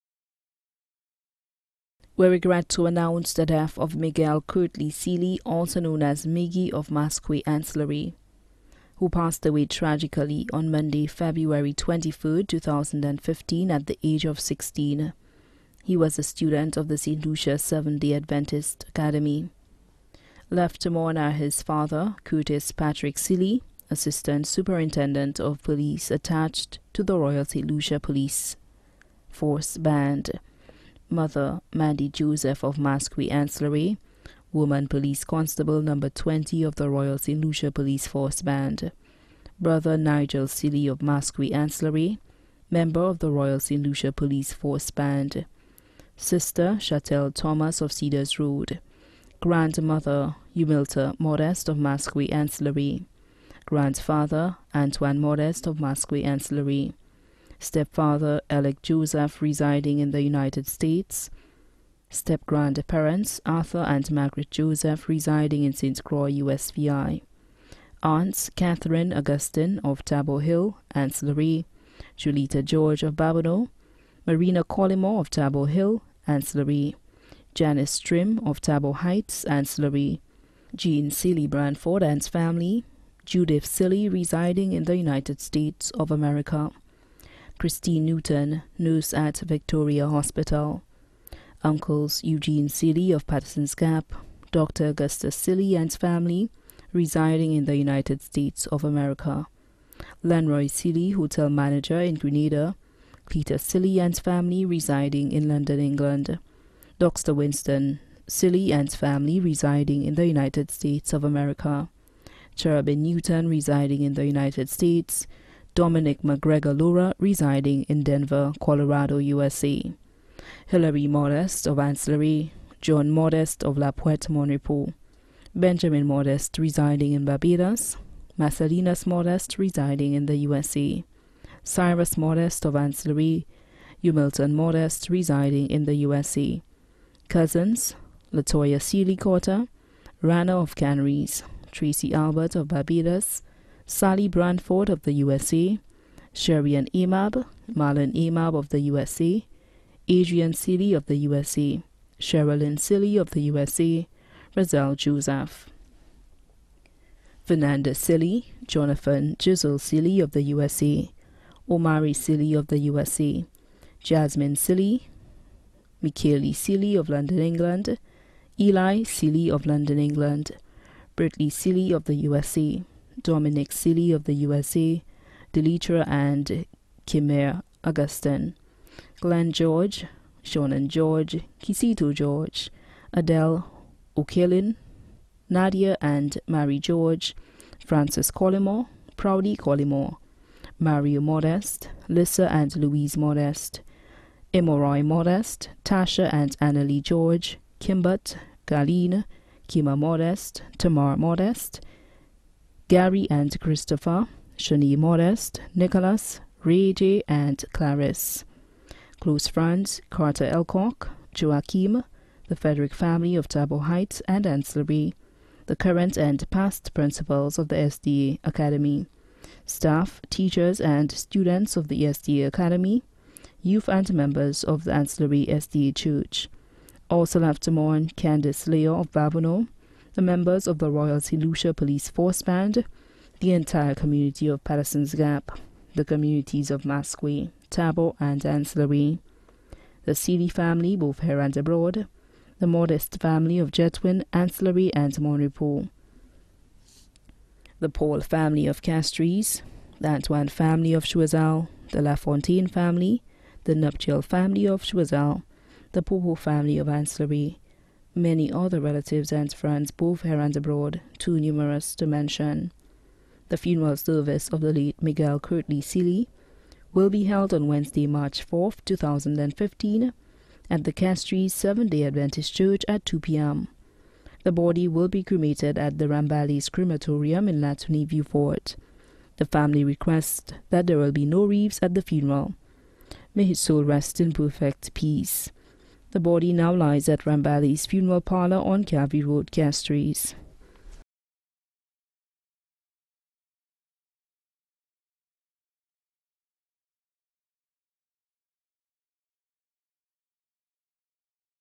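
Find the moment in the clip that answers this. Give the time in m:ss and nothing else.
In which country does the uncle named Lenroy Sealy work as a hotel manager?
1:42.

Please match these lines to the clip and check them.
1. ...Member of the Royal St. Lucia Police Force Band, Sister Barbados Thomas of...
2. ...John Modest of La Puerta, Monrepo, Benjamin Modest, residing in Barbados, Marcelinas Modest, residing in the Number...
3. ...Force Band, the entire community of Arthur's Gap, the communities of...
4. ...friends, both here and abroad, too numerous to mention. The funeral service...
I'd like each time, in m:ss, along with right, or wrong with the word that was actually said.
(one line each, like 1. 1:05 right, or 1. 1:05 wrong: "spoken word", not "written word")
1. 0:42 wrong: "Chatel", not "Barbados"
2. 2:02 wrong: "USA", not "Number"
3. 3:52 wrong: "Patterson", not "Arthur"
4. 4:19 right.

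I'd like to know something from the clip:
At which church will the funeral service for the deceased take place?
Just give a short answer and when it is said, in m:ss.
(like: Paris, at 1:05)
Castries Seventh day Adventist Church, at 4:30.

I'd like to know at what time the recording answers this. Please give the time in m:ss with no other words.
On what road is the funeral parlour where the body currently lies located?
4:48.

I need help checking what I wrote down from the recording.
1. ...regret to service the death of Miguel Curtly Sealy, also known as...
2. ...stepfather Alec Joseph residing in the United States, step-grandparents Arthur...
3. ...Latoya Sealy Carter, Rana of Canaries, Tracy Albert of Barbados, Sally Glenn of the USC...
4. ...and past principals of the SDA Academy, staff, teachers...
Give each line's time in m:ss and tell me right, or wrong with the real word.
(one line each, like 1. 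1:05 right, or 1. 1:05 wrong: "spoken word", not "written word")
1. 0:02 wrong: "announce", not "service"
2. 0:57 right
3. 2:18 wrong: "Branford", not "Glenn"
4. 3:36 right.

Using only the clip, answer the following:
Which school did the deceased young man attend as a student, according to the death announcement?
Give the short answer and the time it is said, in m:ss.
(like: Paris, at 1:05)
St. Lucia Seventh day Adventist Academy, at 0:16.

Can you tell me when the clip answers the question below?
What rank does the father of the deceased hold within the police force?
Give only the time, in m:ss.
0:23.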